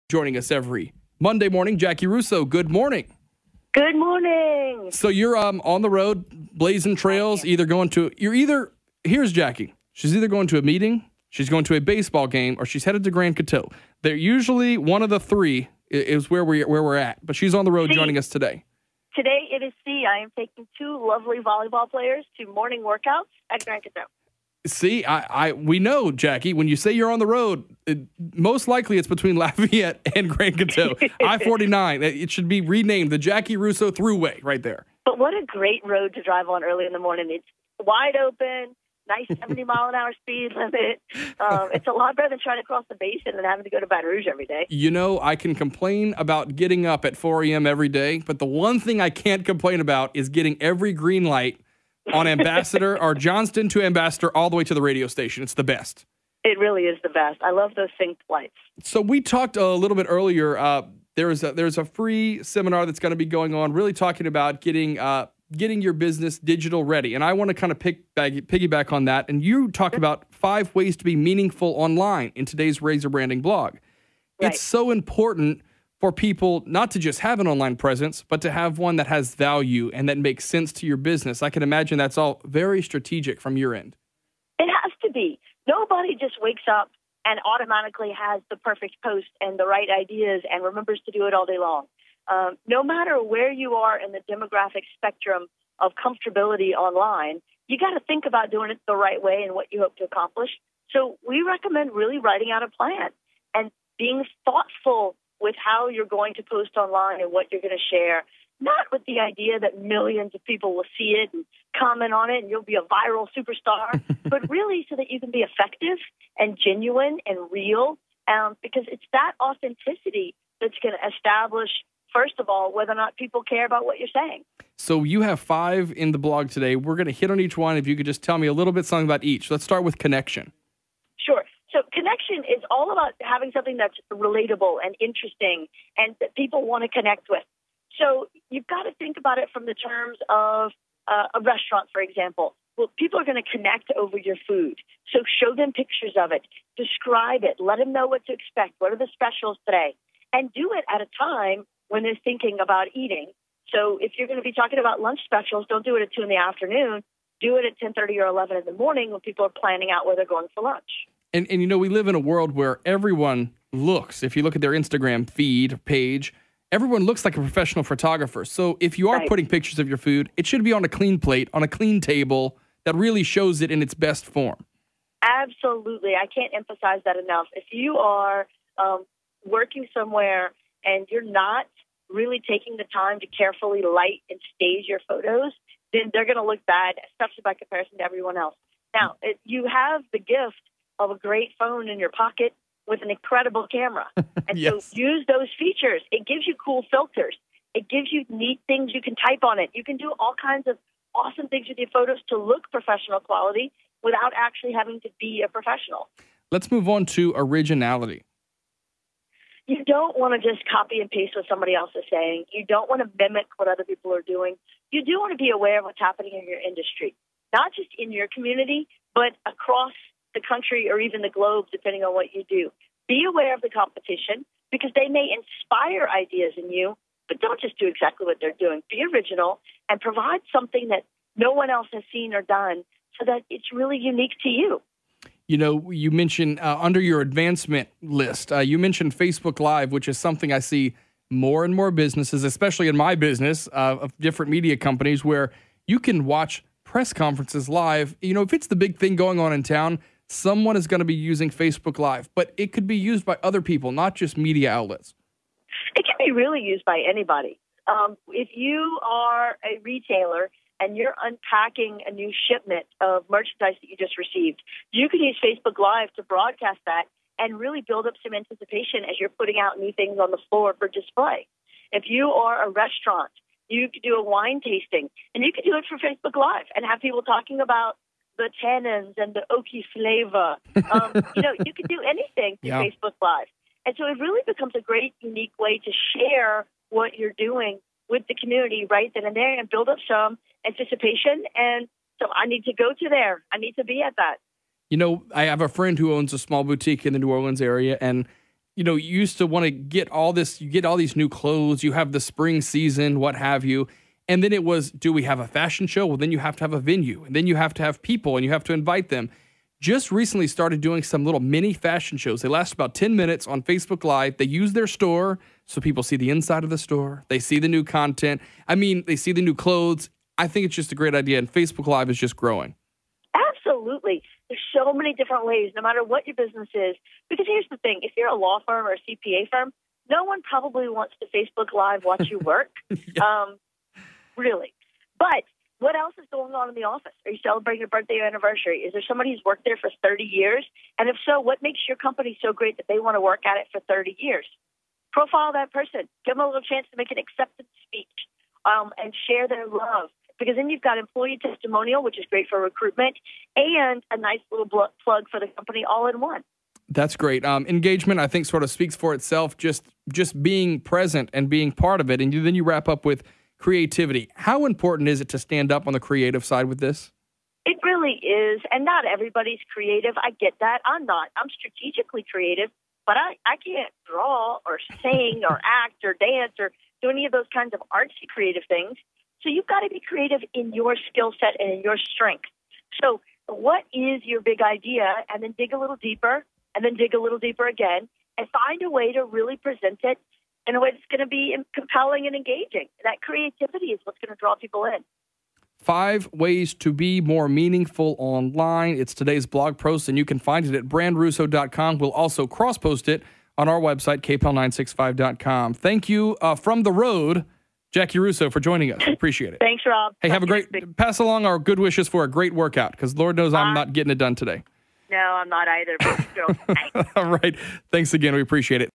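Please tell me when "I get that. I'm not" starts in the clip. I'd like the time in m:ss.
6:10.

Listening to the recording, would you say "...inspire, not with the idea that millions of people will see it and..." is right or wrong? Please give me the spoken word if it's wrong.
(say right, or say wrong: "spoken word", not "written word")
wrong: "share", not "inspire".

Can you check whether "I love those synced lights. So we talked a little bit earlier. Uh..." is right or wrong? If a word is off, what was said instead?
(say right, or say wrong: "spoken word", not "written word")
right.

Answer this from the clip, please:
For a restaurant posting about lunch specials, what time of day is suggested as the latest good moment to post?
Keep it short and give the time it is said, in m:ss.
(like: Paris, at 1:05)
11 in the morning, at 2:38.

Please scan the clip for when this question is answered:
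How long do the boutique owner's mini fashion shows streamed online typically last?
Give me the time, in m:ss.
5:12.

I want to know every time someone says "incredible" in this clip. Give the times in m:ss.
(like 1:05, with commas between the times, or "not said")
3:13.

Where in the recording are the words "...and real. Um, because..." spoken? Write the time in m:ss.
1:57.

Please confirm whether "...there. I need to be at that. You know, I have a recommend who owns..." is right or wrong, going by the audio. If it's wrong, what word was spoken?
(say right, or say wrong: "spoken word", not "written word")
wrong: "friend", not "recommend".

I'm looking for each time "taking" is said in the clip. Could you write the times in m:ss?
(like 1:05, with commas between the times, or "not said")
0:20, 3:02.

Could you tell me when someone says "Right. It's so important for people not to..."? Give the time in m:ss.
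1:14.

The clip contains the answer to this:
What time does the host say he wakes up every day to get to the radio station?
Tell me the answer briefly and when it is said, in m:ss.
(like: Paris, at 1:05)
4 a.m., at 0:47.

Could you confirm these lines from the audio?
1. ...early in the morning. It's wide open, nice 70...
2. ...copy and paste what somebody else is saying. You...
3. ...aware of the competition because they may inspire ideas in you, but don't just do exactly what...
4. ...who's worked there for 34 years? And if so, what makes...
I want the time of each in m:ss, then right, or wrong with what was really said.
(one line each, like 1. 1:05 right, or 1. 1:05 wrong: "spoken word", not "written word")
1. 0:36 right
2. 3:30 right
3. 3:43 right
4. 5:39 wrong: "30", not "34".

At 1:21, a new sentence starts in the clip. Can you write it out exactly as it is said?
I can imagine that's all very strategic from your end.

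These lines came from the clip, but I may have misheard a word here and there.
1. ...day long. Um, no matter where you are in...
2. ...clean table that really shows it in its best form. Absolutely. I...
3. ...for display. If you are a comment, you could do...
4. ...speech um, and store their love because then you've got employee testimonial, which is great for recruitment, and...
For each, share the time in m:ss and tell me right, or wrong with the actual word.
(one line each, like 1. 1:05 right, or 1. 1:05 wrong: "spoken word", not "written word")
1. 1:31 right
2. 2:51 right
3. 4:30 wrong: "restaurant", not "comment"
4. 5:47 wrong: "share", not "store".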